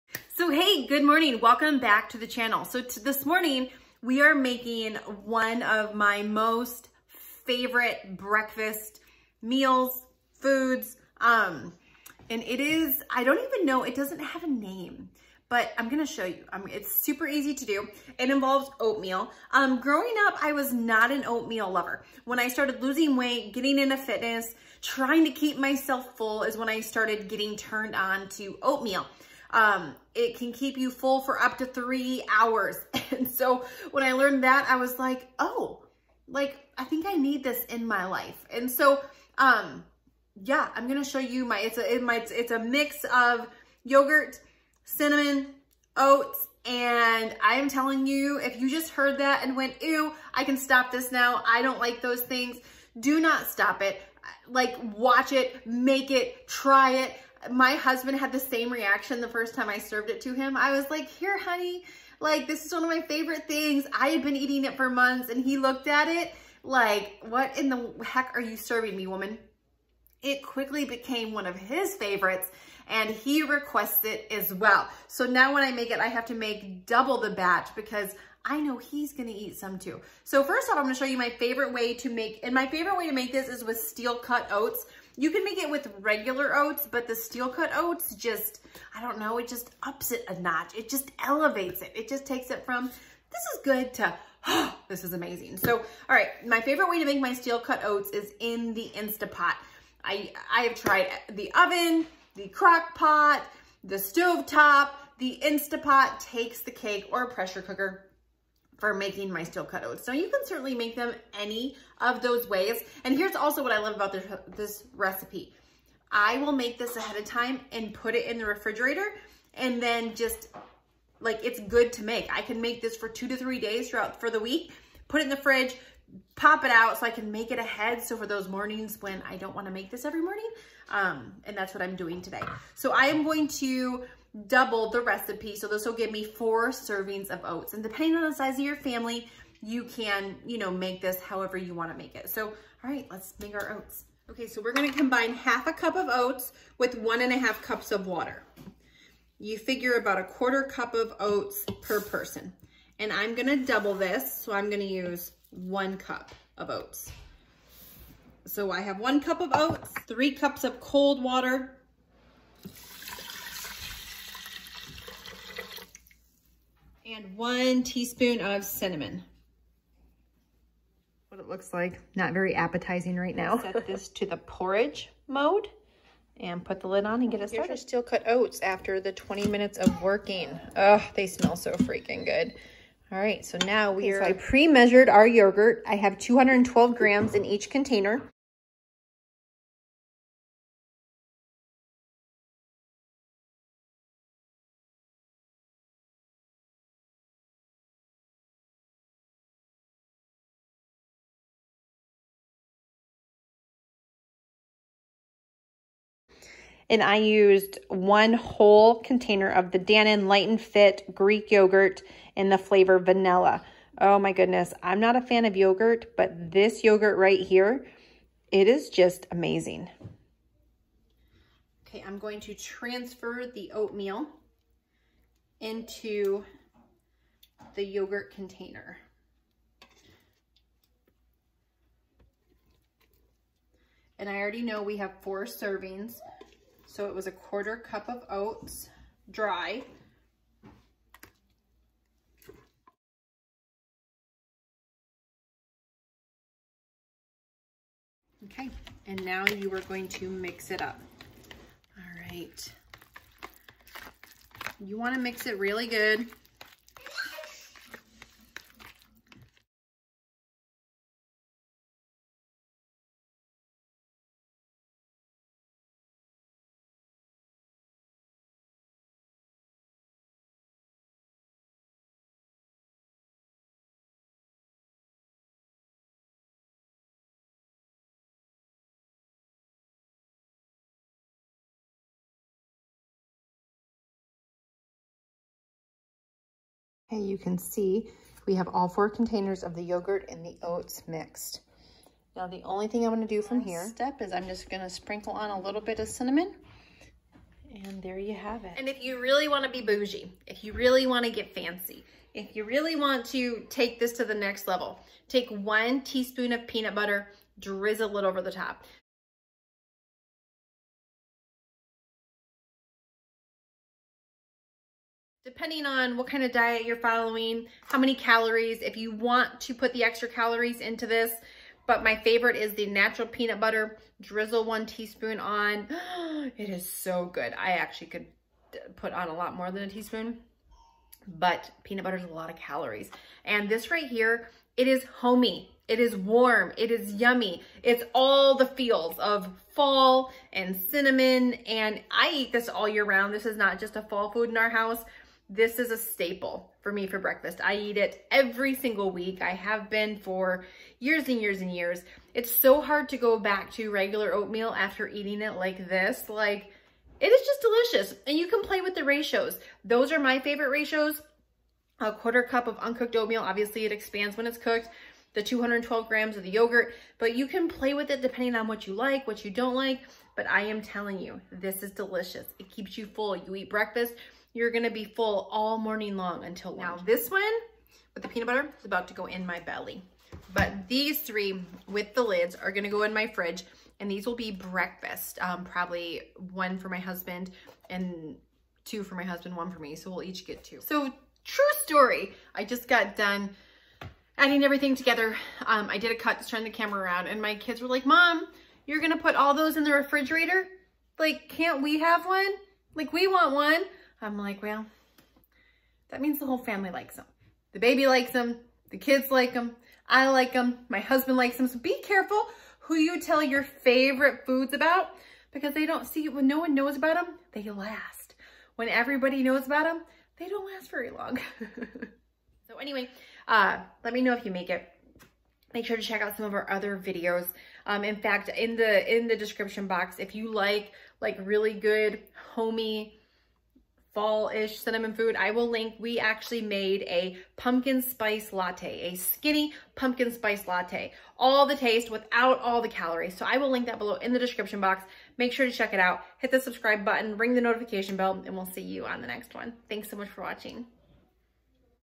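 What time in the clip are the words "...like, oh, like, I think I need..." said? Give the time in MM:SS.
00:34.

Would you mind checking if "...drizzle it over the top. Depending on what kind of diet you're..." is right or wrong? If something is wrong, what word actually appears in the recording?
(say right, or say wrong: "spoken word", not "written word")
right.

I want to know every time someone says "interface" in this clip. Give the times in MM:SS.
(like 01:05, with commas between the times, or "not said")
not said.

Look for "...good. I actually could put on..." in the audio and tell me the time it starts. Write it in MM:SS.
05:27.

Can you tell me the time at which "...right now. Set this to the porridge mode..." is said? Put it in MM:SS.
02:53.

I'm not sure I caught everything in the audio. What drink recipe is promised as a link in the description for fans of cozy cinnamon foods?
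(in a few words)
skinny pumpkin spice latte.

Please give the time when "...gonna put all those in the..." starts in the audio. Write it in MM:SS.
06:38.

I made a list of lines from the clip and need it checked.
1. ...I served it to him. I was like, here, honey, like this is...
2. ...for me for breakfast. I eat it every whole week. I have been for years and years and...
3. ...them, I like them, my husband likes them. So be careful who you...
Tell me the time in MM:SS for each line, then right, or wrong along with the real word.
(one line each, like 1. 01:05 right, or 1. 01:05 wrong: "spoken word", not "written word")
1. 00:59 right
2. 05:46 wrong: "single", not "whole"
3. 06:49 right.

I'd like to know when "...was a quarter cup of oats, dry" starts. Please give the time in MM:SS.
03:57.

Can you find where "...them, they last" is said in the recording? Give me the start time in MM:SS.
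06:57.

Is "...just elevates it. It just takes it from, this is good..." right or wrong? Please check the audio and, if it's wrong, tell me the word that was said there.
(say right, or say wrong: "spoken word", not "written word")
right.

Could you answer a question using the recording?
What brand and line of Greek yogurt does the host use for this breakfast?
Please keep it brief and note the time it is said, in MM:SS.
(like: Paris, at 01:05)
Dannon Light and Fit, at 03:29.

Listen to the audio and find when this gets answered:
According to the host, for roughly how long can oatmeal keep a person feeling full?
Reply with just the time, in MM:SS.
00:31.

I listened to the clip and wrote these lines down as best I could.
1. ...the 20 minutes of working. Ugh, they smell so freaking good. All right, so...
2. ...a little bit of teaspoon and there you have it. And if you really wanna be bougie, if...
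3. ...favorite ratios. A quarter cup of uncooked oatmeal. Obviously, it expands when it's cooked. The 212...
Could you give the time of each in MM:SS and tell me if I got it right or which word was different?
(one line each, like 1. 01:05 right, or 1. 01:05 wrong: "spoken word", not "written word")
1. 02:58 right
2. 04:55 wrong: "cinnamon", not "teaspoon"
3. 06:00 right.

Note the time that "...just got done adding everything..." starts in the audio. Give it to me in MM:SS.
06:32.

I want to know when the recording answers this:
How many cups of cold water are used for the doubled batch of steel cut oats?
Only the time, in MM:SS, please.
02:40.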